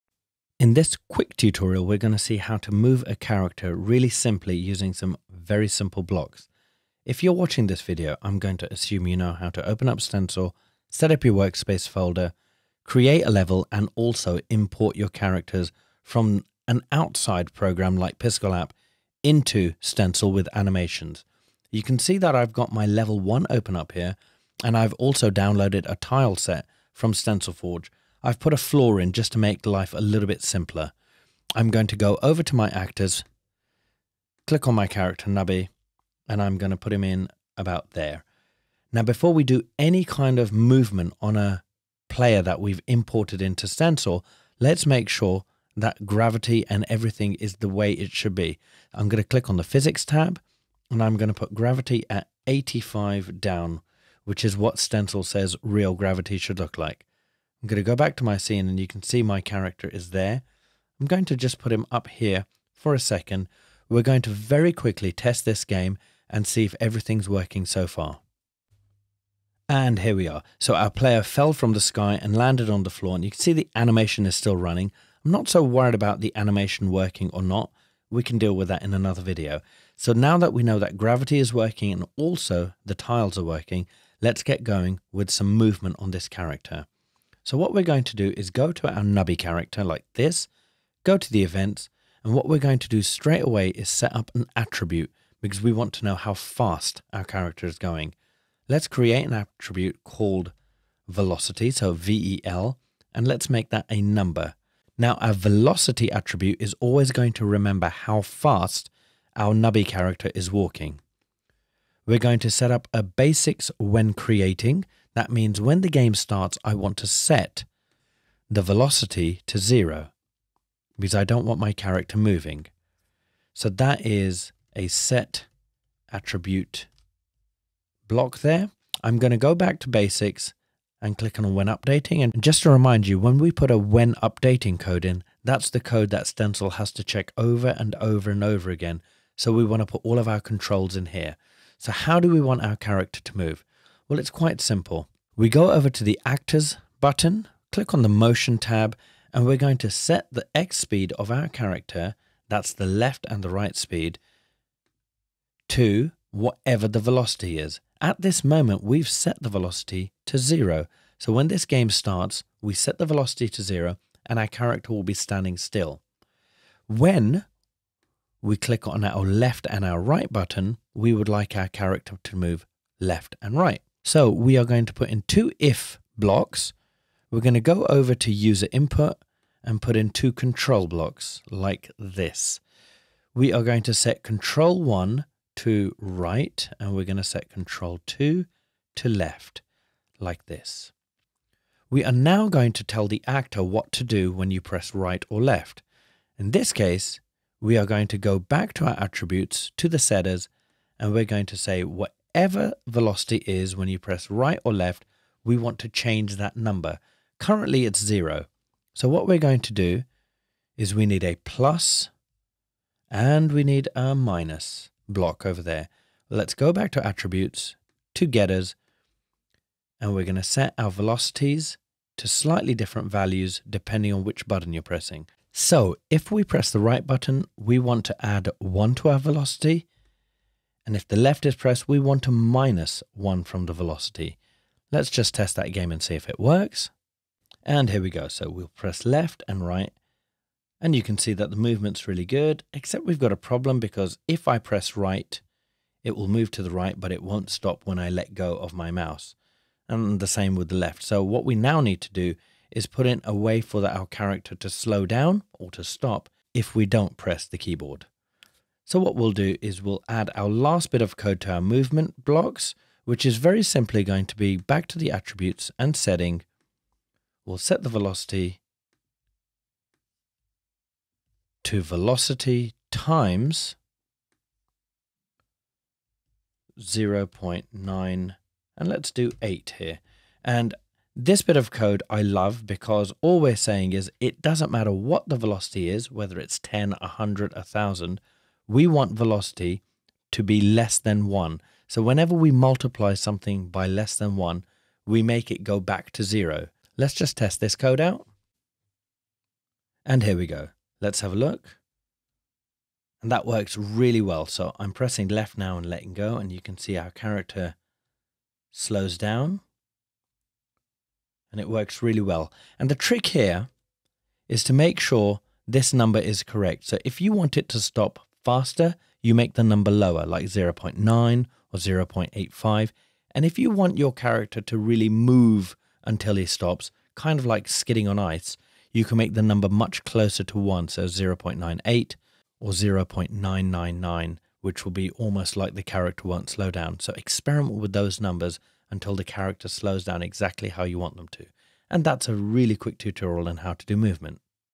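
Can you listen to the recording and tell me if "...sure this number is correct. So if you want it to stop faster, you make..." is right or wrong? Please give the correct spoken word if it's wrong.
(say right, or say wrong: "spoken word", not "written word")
right.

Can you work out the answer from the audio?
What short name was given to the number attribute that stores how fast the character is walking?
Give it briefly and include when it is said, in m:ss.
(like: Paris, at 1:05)
VEL, at 1:41.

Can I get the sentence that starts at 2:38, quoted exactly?
At this moment, we've set the velocity to zero.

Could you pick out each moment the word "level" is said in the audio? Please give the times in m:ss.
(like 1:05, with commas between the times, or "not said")
0:13, 0:22.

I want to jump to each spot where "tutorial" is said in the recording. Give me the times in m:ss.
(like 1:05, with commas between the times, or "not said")
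0:01, 5:42.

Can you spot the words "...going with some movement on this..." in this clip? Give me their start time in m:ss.
1:24.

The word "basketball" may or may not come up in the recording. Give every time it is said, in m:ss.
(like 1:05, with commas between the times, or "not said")
not said.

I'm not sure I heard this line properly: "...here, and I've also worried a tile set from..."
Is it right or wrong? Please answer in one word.
wrong.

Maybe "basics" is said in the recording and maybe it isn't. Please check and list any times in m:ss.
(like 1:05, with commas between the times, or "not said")
1:53, 2:09.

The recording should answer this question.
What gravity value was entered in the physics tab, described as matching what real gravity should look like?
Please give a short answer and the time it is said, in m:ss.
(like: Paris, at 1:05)
85, at 0:52.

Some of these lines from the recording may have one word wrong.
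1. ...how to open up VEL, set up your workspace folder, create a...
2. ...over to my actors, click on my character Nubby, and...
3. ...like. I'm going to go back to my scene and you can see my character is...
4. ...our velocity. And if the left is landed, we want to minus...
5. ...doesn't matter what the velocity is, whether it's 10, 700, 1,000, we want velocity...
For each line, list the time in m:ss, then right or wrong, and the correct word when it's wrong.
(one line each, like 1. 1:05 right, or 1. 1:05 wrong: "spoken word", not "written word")
1. 0:09 wrong: "Stencyl", not "VEL"
2. 0:32 right
3. 0:56 right
4. 3:49 wrong: "pressed", not "landed"
5. 4:44 wrong: "100", not "700".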